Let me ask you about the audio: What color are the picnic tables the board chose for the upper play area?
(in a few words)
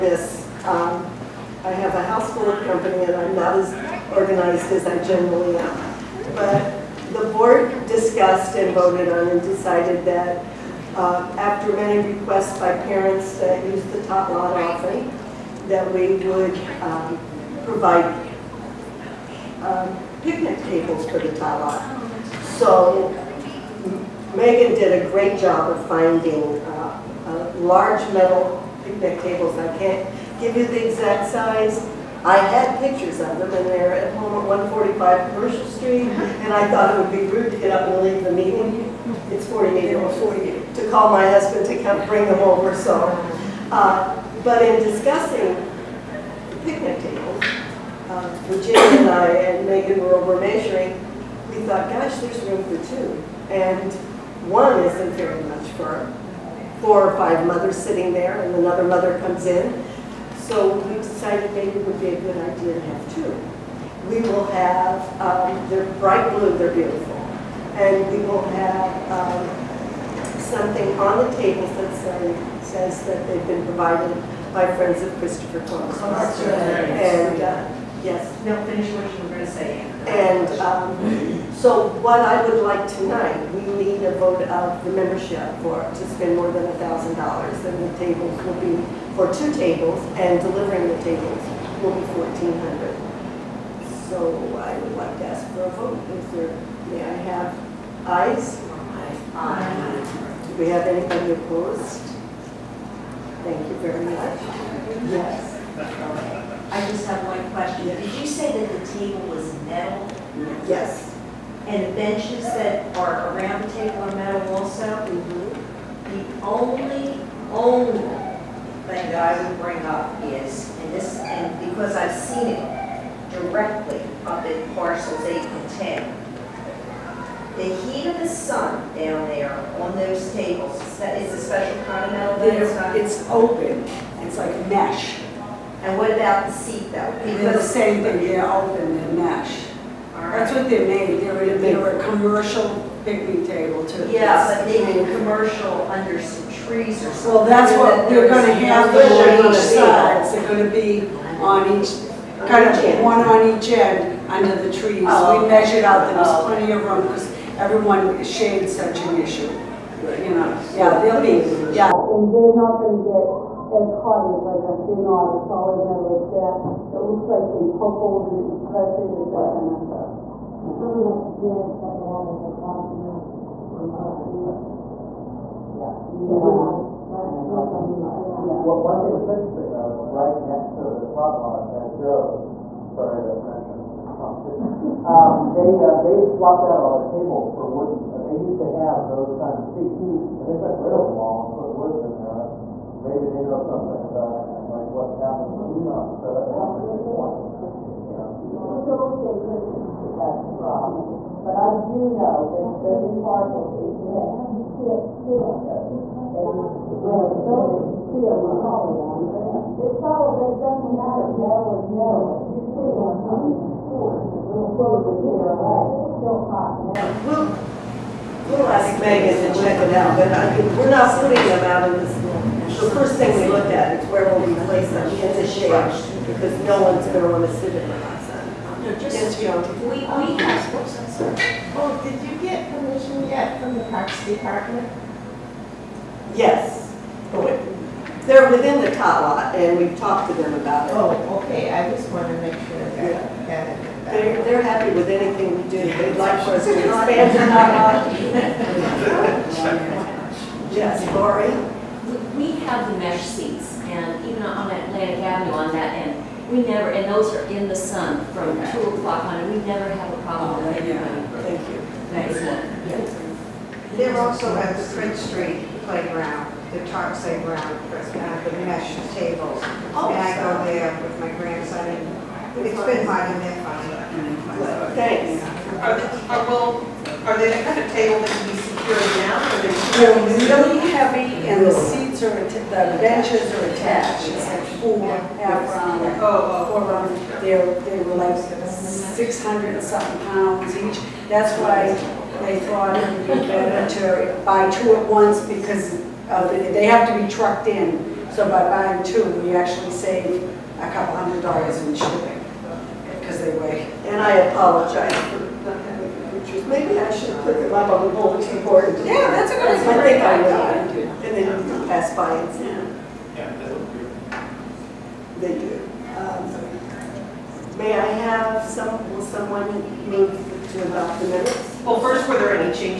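Bright blue.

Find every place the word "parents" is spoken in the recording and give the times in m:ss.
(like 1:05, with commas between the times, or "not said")
0:12.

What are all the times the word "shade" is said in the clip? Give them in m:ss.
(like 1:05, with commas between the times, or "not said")
2:38, 3:45.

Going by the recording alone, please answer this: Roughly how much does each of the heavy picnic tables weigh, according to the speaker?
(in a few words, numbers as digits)
600 and something pounds.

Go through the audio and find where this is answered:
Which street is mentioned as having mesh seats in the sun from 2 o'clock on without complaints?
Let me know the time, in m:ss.
4:14.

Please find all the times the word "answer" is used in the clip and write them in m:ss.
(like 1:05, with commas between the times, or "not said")
not said.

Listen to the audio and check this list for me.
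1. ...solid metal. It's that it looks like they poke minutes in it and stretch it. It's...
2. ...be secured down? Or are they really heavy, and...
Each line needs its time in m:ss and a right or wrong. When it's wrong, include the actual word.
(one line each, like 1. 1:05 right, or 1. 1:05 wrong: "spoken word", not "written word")
1. 2:45 wrong: "holes", not "minutes"
2. 4:38 right.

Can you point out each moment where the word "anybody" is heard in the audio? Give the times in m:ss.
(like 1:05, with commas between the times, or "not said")
1:40, 4:20.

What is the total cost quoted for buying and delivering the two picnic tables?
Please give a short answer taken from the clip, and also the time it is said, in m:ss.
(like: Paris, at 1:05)
$1,400, at 1:32.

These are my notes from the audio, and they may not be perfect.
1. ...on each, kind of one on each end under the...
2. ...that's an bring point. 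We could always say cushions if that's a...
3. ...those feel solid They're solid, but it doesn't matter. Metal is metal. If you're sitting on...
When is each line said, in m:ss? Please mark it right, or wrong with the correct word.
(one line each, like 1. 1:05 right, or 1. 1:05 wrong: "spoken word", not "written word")
1. 2:31 right
2. 3:16 wrong: "interesting", not "bring"
3. 3:27 right.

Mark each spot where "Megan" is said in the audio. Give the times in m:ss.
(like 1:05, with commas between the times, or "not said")
0:24, 0:49, 3:38.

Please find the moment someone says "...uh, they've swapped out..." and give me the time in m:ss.
3:05.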